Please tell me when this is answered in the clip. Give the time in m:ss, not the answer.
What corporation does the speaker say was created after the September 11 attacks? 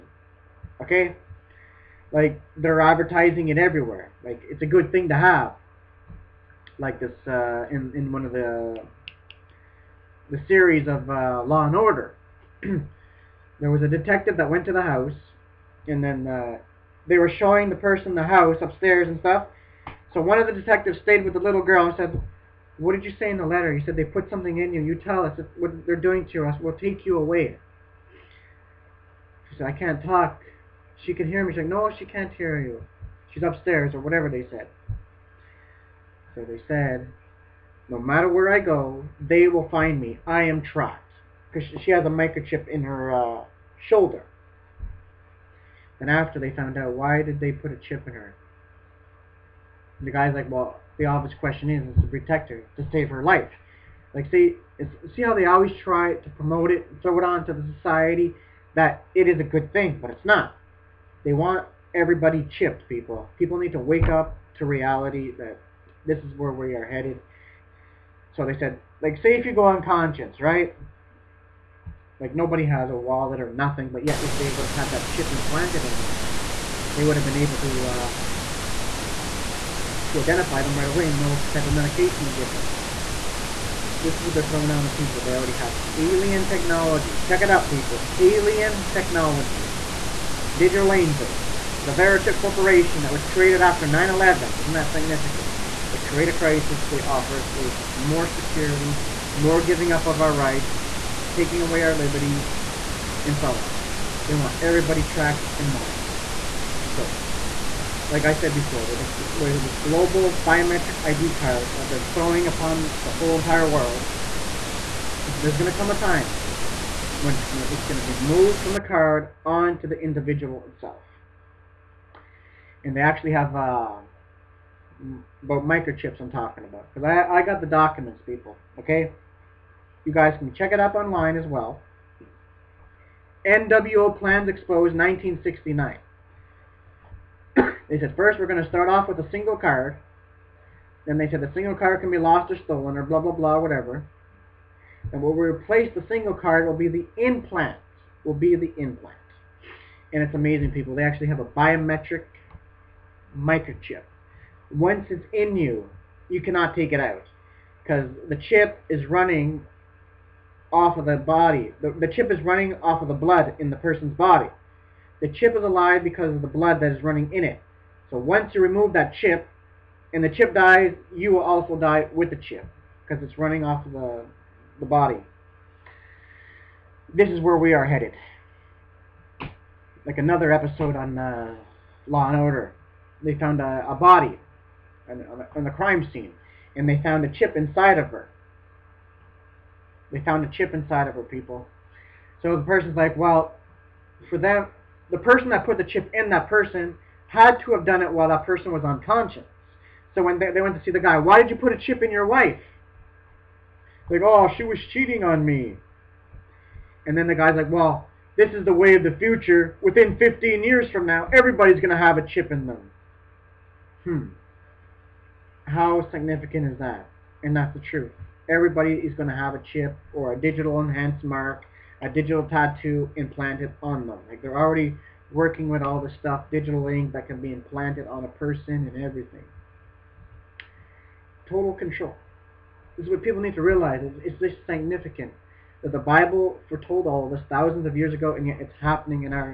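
1:31.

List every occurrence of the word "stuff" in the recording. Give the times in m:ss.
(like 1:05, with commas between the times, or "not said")
0:19, 3:46.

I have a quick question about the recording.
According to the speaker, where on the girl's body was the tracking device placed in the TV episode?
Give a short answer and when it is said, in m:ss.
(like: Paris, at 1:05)
Shoulder, at 0:43.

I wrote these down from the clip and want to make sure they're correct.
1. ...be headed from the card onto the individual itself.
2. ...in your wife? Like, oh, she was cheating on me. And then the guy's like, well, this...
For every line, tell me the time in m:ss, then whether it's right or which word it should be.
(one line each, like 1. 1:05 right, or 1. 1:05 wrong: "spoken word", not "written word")
1. 1:58 wrong: "moved", not "headed"
2. 3:22 right.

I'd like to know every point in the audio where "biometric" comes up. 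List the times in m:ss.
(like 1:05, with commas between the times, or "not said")
1:50, 2:31.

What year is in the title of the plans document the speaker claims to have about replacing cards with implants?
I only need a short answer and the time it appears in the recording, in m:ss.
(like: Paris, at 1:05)
1969, at 2:14.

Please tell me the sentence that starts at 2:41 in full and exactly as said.
The, the chip is running off of the blood in the person's body.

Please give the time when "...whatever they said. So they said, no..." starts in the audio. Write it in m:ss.
0:34.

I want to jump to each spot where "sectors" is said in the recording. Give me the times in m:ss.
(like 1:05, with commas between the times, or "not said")
not said.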